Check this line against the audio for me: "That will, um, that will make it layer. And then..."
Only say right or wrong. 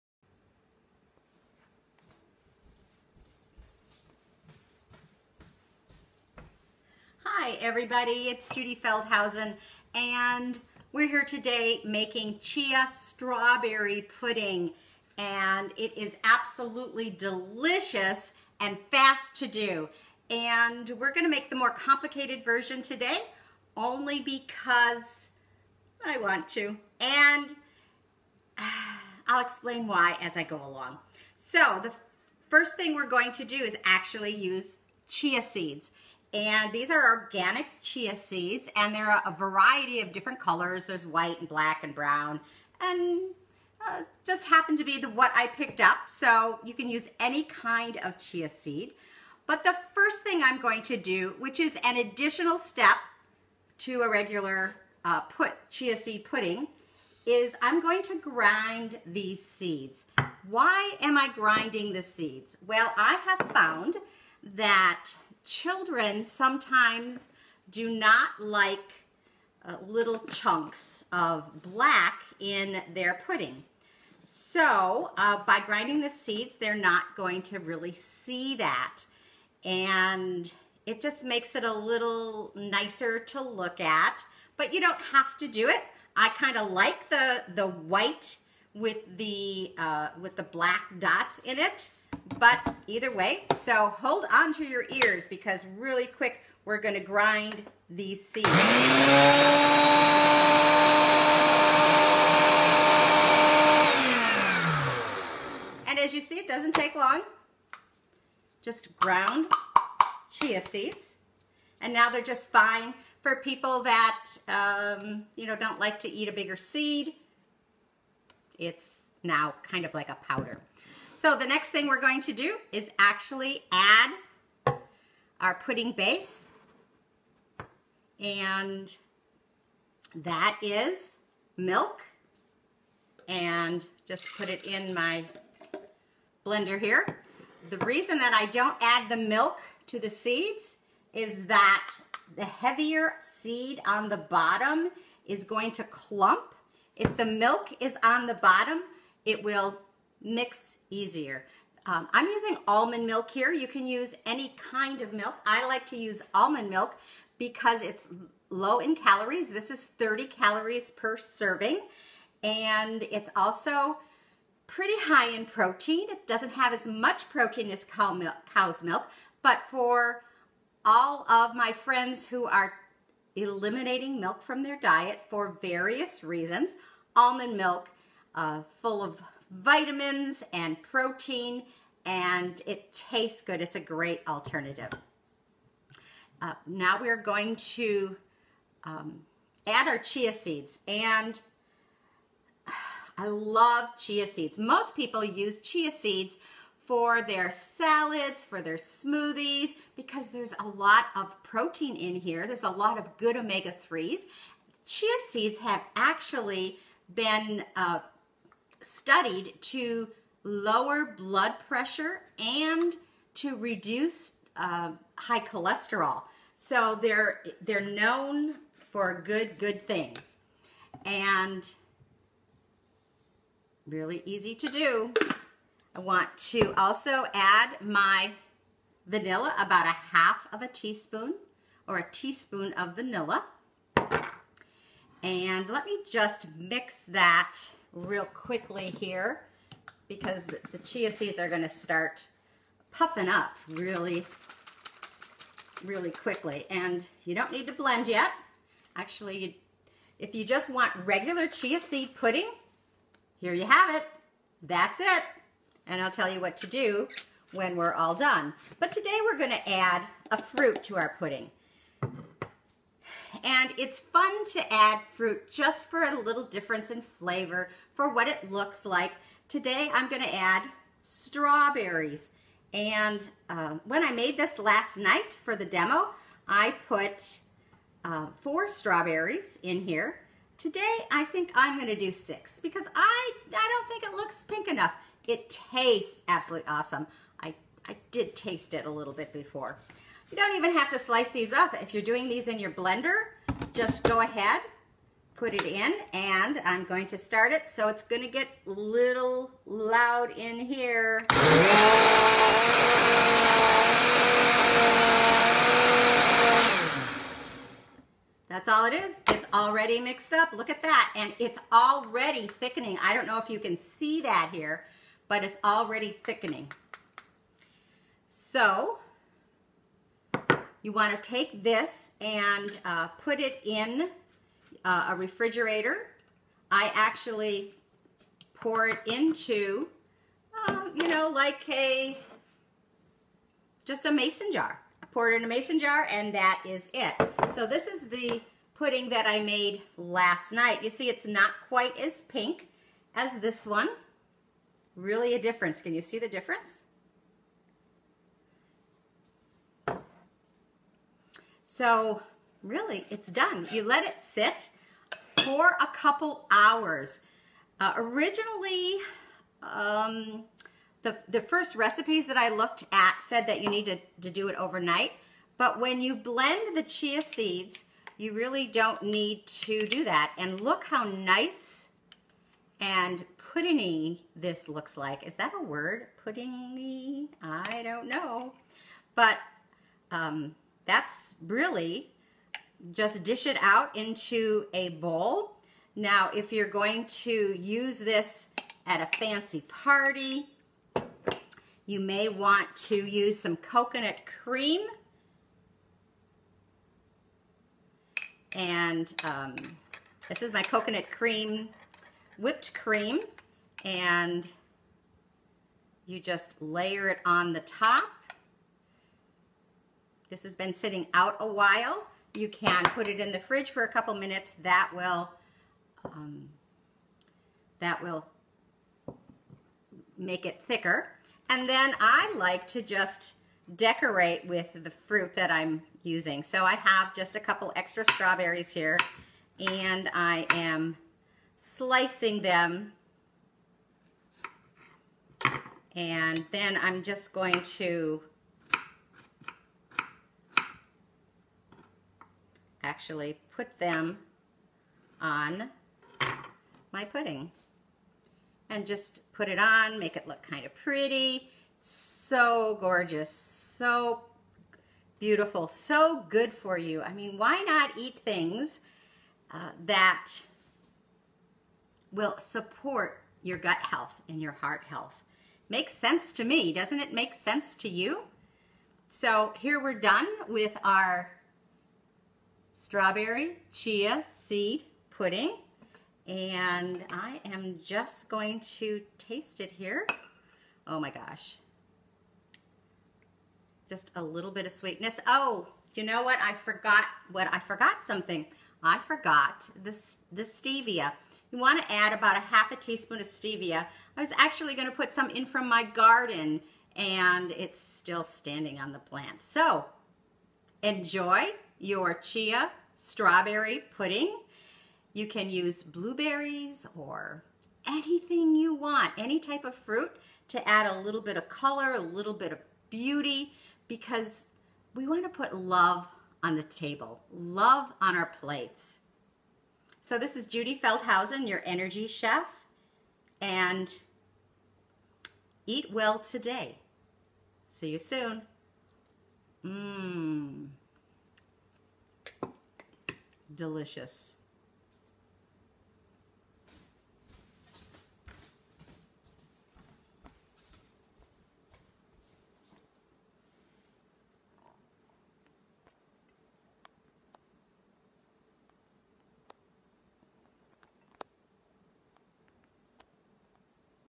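wrong.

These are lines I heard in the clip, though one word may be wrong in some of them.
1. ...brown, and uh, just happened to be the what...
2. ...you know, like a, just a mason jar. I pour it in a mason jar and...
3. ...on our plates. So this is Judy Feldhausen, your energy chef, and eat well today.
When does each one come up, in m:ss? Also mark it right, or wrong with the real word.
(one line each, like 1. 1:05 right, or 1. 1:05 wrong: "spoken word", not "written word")
1. 0:41 right
2. 5:30 right
3. 8:38 right.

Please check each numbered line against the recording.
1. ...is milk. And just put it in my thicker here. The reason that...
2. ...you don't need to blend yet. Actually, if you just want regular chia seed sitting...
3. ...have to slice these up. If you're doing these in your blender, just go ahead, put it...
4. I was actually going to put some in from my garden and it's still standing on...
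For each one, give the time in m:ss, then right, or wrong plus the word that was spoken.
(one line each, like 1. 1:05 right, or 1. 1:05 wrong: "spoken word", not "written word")
1. 2:10 wrong: "blender", not "thicker"
2. 4:07 wrong: "pudding", not "sitting"
3. 4:50 right
4. 8:14 right.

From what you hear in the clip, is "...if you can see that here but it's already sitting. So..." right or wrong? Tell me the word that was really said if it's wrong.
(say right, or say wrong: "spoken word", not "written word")
wrong: "thickening", not "sitting".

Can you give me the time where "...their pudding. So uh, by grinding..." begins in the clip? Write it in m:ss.
1:12.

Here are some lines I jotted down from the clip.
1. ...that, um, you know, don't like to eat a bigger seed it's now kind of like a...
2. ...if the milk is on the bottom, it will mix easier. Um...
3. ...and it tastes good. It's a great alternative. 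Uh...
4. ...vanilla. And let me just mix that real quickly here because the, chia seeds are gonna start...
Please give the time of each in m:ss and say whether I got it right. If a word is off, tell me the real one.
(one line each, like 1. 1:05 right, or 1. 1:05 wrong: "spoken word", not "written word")
1. 1:53 right
2. 2:26 right
3. 3:02 right
4. 3:52 right.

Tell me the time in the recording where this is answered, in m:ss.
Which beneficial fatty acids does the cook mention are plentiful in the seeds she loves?
3:23.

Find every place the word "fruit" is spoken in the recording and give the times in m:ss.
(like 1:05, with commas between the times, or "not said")
4:20, 4:25, 7:04, 8:29.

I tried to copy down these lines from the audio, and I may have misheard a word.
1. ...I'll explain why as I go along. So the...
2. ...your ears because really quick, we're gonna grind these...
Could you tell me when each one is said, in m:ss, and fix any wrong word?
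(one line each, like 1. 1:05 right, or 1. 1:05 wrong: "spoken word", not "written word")
1. 0:29 right
2. 1:34 right.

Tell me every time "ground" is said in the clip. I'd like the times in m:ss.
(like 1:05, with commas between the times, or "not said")
1:48.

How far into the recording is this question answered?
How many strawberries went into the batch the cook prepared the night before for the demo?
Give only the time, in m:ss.
4:38.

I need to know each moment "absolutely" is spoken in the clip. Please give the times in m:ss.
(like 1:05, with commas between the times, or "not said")
0:16, 4:46.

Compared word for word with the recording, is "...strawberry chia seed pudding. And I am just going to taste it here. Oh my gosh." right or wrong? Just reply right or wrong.
right.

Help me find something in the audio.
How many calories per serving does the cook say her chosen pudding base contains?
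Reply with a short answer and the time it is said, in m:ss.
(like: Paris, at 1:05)
30, at 2:39.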